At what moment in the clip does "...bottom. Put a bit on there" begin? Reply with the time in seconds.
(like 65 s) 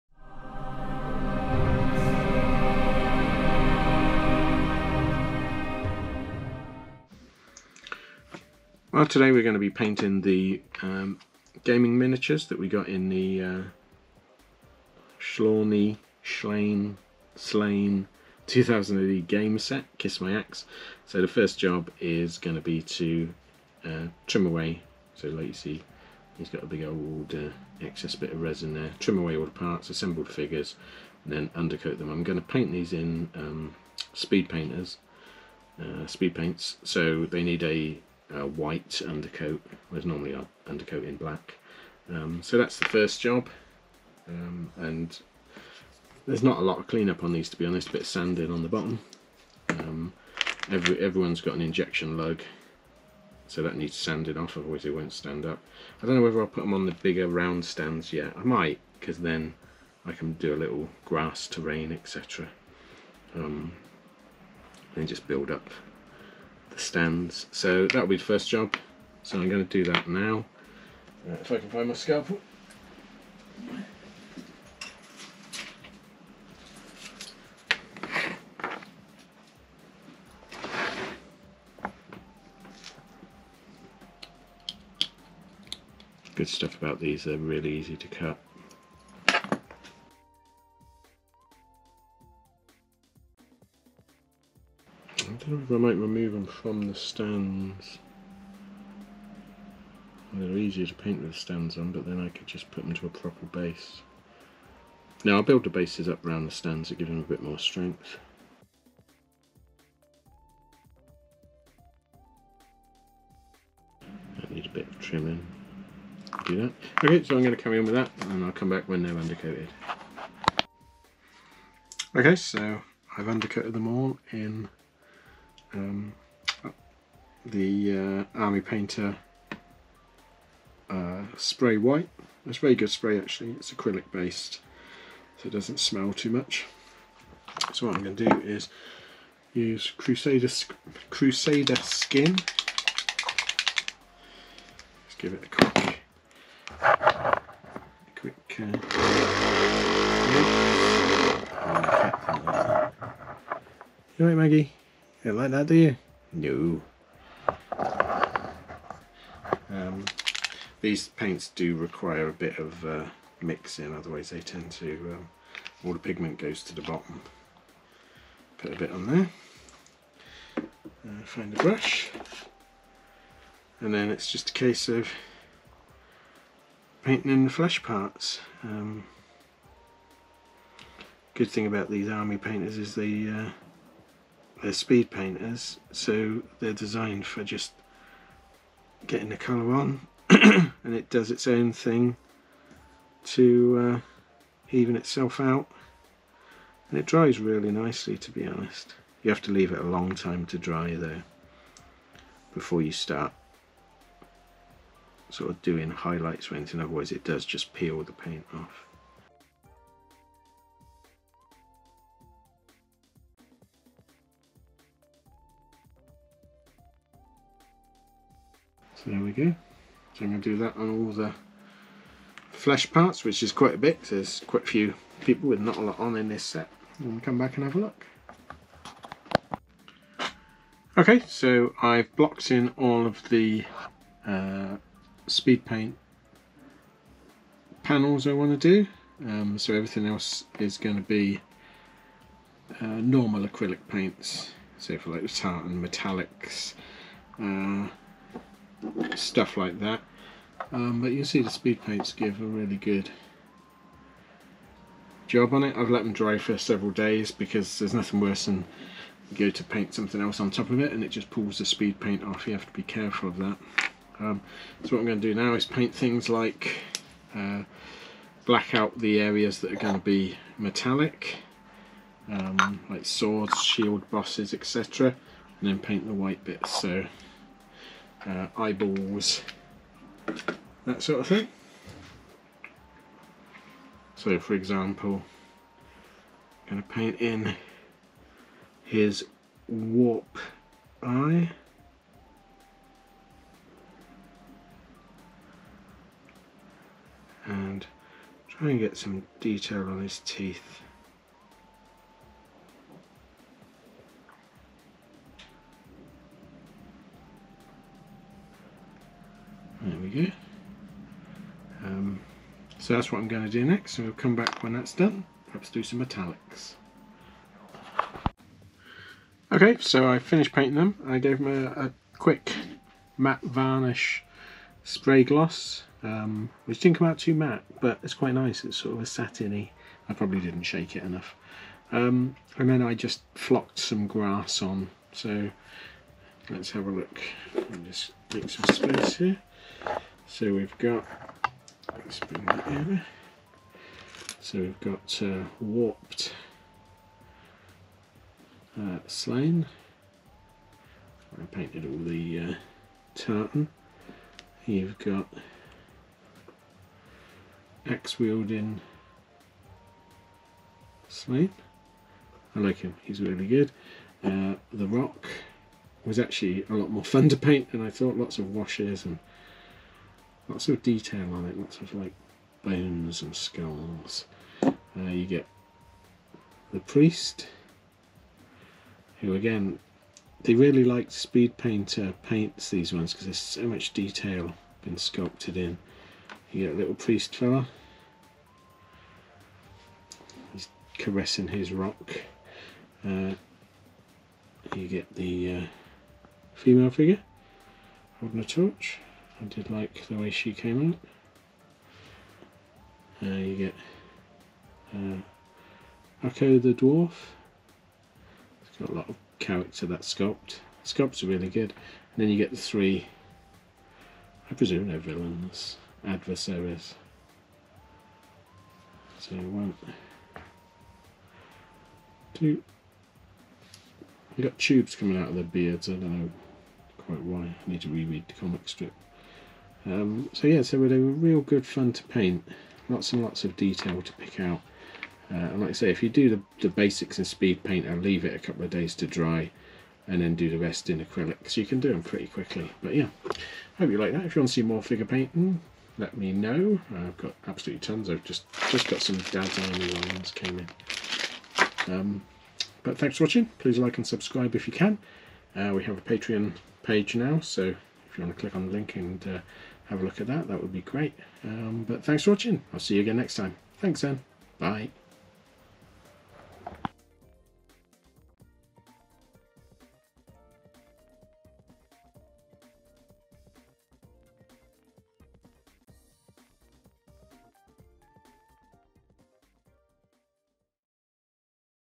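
166 s.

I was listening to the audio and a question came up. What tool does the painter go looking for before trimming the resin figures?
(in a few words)
Scalpel.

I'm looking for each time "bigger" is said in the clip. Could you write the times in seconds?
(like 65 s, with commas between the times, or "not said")
56 s.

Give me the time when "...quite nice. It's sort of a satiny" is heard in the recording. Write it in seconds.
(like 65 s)
328 s.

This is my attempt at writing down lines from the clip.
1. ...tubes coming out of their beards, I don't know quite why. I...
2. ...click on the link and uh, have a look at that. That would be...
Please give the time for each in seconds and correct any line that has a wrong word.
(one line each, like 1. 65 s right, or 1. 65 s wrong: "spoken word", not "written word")
1. 424 s right
2. 458 s right.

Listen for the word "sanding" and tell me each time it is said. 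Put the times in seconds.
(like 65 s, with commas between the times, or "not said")
48 s, 53 s.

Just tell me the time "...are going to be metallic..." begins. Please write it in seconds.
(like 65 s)
269 s.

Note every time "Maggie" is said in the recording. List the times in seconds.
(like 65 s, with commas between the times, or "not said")
154 s.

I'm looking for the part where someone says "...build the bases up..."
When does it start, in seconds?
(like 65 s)
105 s.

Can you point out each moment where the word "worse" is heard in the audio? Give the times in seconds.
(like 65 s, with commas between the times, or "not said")
258 s.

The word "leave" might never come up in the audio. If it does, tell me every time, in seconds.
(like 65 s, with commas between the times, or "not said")
199 s, 438 s.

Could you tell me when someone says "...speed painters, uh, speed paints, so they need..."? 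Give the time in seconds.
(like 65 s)
34 s.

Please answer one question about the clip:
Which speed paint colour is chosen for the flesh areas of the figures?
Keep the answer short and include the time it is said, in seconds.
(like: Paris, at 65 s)
Crusader Skin, at 141 s.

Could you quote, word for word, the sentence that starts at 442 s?
But yeah, hope you like that.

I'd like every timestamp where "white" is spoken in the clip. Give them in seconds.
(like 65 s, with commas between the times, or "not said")
38 s, 131 s, 276 s.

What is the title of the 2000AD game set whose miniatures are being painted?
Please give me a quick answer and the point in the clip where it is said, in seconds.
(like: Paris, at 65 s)
Kiss My Axe, at 19 s.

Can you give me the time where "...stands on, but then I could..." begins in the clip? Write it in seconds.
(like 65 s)
101 s.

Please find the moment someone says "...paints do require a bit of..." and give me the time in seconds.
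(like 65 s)
161 s.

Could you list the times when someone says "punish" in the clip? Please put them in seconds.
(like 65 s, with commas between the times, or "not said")
not said.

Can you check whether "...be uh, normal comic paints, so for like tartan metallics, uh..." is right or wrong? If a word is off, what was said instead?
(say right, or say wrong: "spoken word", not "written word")
wrong: "acrylic", not "comic".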